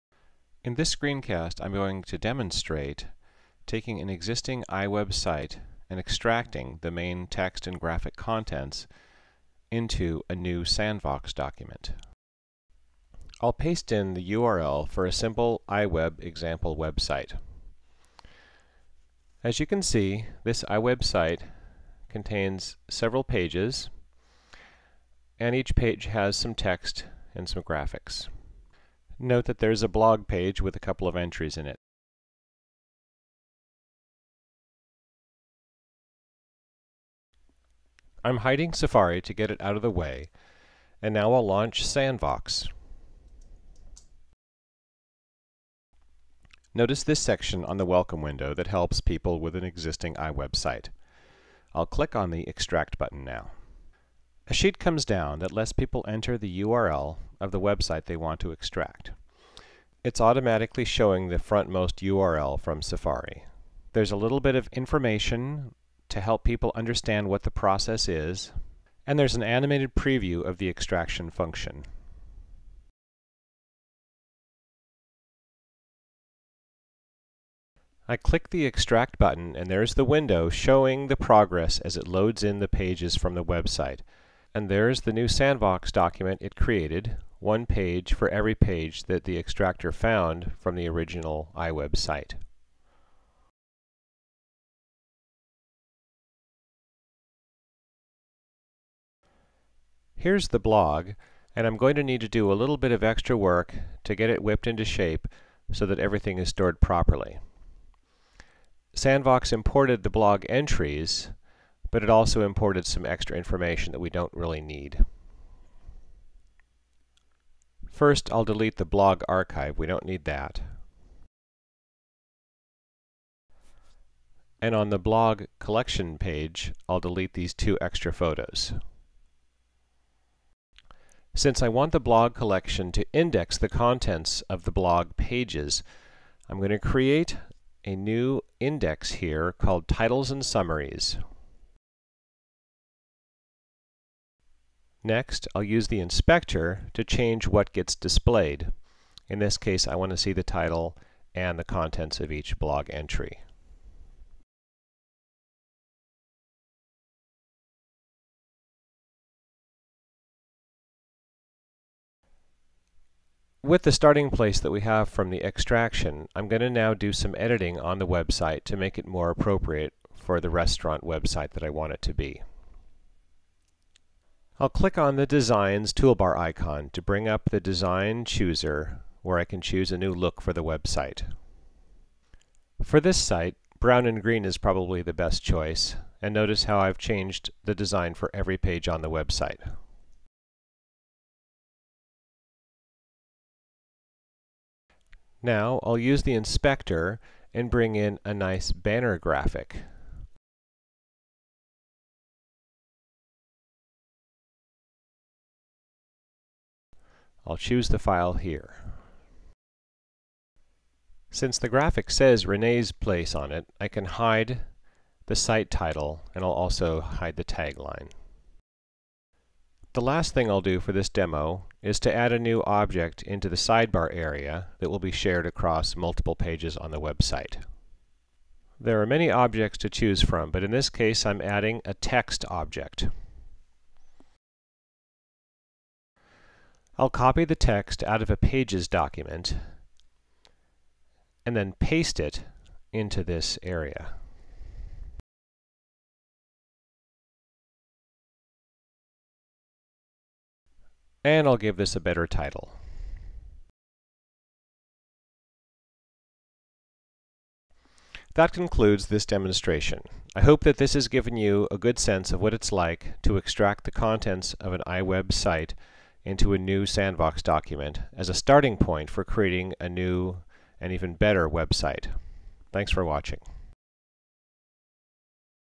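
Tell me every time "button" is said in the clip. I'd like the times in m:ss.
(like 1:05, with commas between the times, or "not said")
0:52, 1:19.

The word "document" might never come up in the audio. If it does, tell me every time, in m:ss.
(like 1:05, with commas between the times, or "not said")
0:11, 1:25, 3:58, 4:27.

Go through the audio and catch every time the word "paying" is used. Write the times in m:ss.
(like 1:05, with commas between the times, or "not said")
not said.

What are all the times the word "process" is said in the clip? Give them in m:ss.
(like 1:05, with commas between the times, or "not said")
1:07.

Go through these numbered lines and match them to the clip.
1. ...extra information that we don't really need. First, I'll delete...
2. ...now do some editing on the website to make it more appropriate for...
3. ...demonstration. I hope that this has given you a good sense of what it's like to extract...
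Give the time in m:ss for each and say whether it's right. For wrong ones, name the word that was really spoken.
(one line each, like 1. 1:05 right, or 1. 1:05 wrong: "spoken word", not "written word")
1. 1:53 right
2. 2:46 right
3. 4:19 right.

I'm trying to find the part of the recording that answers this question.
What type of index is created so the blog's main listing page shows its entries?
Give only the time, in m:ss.
2:19.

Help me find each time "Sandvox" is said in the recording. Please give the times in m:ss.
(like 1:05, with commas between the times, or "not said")
0:10, 0:41, 1:25, 1:48, 4:26.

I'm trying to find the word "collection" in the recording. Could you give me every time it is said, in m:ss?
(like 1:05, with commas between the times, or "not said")
2:05, 2:12.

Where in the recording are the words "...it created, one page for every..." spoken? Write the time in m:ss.
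1:26.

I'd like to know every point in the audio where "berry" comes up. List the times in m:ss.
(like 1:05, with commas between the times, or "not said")
not said.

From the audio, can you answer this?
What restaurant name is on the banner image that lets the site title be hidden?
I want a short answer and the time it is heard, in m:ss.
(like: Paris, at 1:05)
Renee's Place, at 3:32.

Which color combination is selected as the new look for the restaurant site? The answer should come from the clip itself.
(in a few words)
brown and green.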